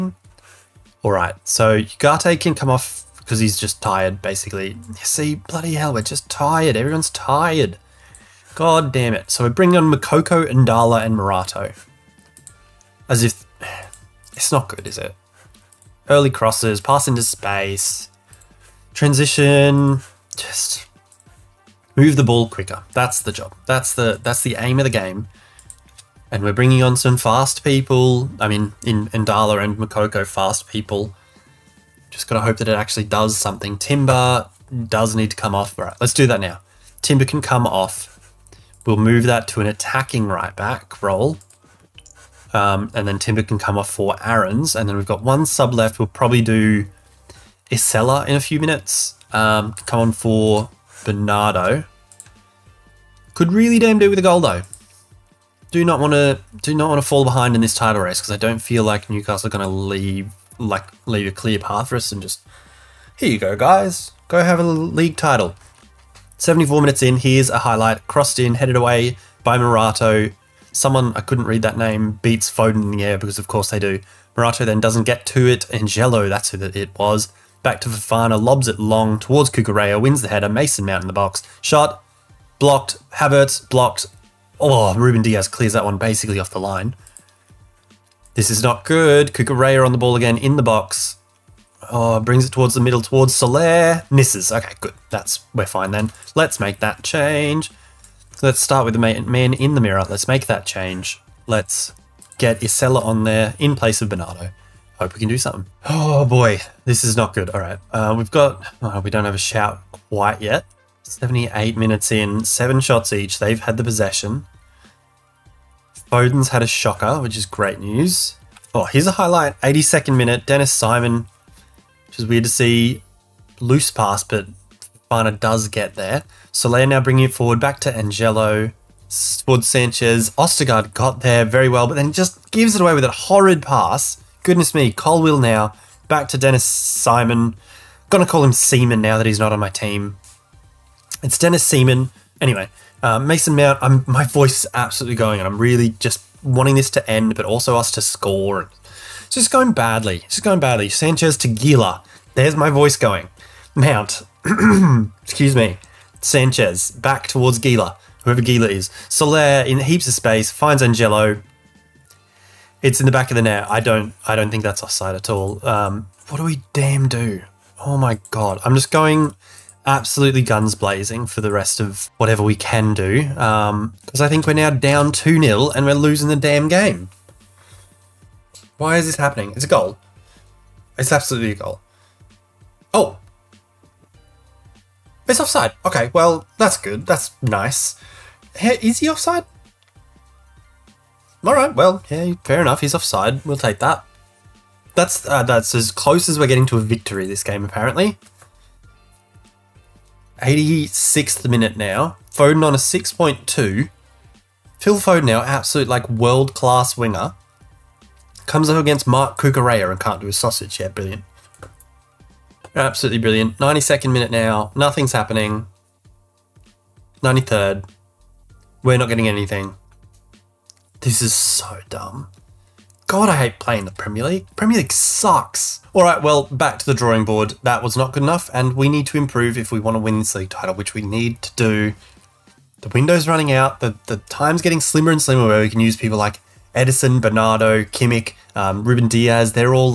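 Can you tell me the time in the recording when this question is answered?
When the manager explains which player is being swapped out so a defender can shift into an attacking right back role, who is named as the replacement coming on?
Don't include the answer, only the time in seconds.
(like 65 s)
44 s.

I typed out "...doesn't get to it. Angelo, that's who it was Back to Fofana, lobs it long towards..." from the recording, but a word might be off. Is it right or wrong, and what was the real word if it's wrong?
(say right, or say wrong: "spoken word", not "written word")
right.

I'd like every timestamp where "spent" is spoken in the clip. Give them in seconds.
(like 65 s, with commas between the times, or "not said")
not said.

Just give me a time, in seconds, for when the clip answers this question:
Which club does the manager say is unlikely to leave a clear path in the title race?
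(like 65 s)
59 s.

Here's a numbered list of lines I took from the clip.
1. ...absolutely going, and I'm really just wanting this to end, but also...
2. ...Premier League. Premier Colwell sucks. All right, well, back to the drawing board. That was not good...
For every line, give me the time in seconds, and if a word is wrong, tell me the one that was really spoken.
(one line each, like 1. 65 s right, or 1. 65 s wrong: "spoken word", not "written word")
1. 144 s right
2. 223 s wrong: "League", not "Colwell".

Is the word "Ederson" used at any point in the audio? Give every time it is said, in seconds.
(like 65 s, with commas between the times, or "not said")
236 s.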